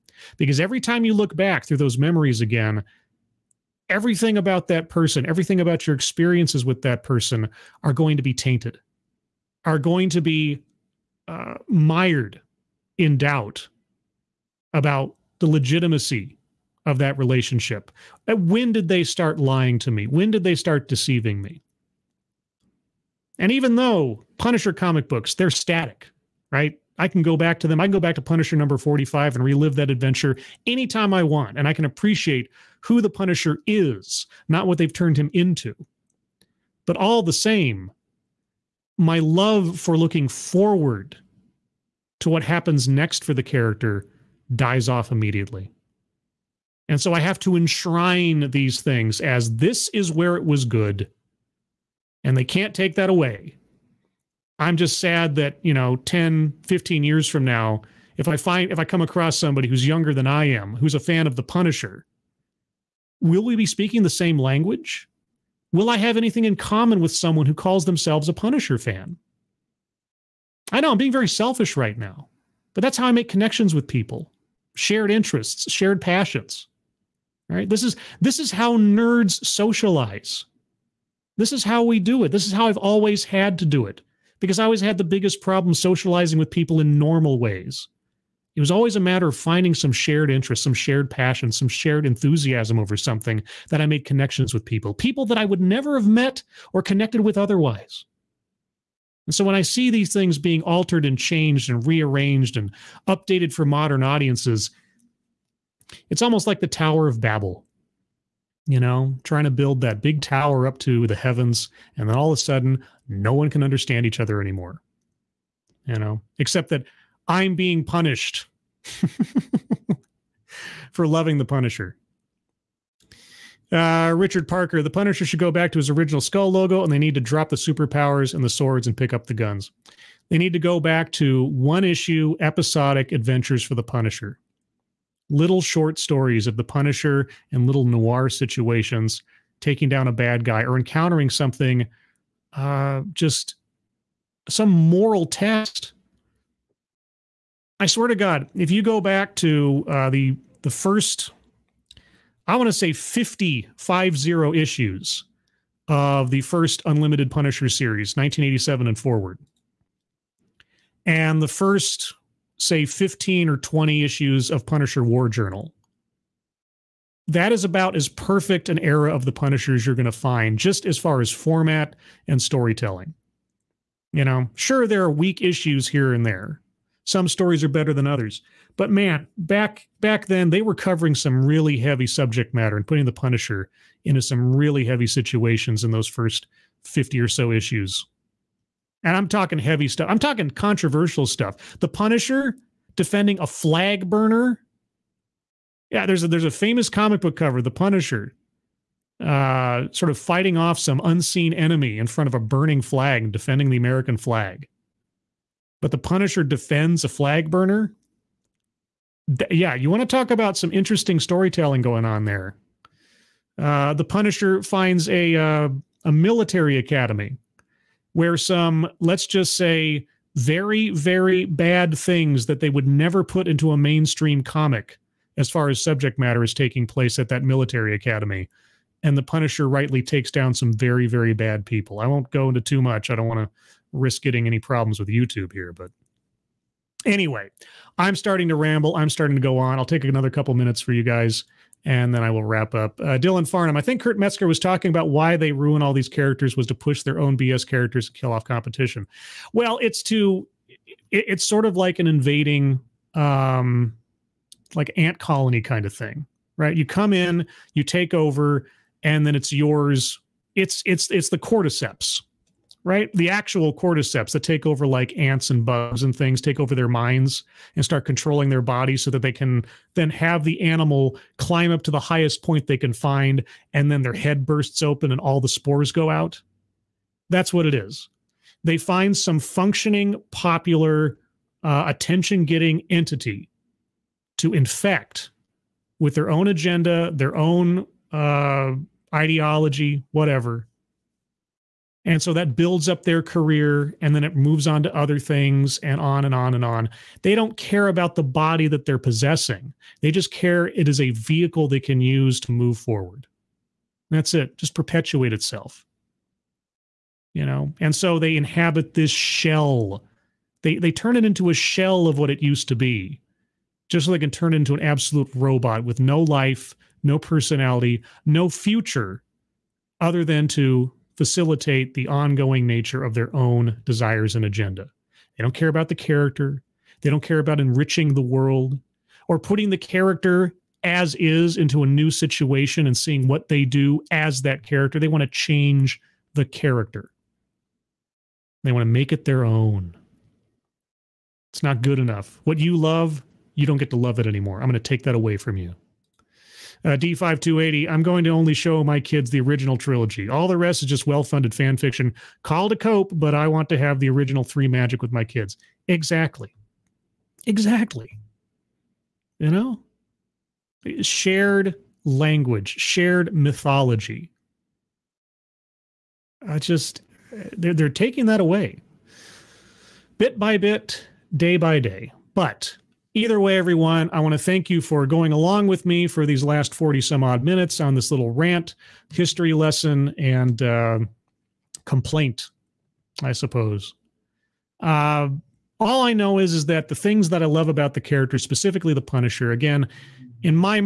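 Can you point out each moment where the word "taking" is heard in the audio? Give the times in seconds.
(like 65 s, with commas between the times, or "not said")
139 s, 226 s, 367 s.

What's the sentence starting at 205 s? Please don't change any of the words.
But the Punisher defends a flag burner.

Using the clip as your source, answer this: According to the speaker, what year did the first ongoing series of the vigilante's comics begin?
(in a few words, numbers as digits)
1987.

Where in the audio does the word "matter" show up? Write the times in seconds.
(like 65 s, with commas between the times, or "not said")
88 s, 182 s, 226 s.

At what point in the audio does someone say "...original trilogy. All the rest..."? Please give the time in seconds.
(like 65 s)
349 s.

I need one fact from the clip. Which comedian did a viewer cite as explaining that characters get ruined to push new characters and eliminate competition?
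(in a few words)
Kurt Metzger.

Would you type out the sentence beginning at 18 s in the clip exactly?
Uh, when did they start lying to me?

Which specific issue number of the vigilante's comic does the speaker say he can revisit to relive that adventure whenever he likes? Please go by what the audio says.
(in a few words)
45.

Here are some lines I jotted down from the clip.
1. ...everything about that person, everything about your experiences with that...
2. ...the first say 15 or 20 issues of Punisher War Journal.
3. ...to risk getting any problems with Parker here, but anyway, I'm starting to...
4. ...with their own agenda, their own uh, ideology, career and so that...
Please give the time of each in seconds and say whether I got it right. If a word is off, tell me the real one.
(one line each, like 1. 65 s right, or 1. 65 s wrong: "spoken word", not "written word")
1. 3 s right
2. 161 s right
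3. 233 s wrong: "YouTube", not "Parker"
4. 285 s wrong: "whatever", not "career".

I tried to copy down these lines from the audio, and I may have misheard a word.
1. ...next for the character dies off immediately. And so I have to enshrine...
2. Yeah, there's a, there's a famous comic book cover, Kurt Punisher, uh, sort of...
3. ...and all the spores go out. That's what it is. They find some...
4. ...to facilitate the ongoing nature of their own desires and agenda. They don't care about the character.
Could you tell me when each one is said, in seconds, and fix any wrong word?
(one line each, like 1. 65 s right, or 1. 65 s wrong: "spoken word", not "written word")
1. 42 s right
2. 195 s wrong: "The", not "Kurt"
3. 275 s right
4. 320 s right.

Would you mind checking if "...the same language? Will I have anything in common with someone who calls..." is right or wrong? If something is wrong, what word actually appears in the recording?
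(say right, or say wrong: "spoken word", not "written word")
right.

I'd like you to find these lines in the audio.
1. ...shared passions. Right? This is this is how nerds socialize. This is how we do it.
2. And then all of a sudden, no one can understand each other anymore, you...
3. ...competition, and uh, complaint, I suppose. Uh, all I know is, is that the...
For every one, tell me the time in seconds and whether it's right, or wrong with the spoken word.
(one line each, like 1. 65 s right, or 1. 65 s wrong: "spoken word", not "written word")
1. 75 s right
2. 111 s right
3. 379 s wrong: "lesson", not "competition".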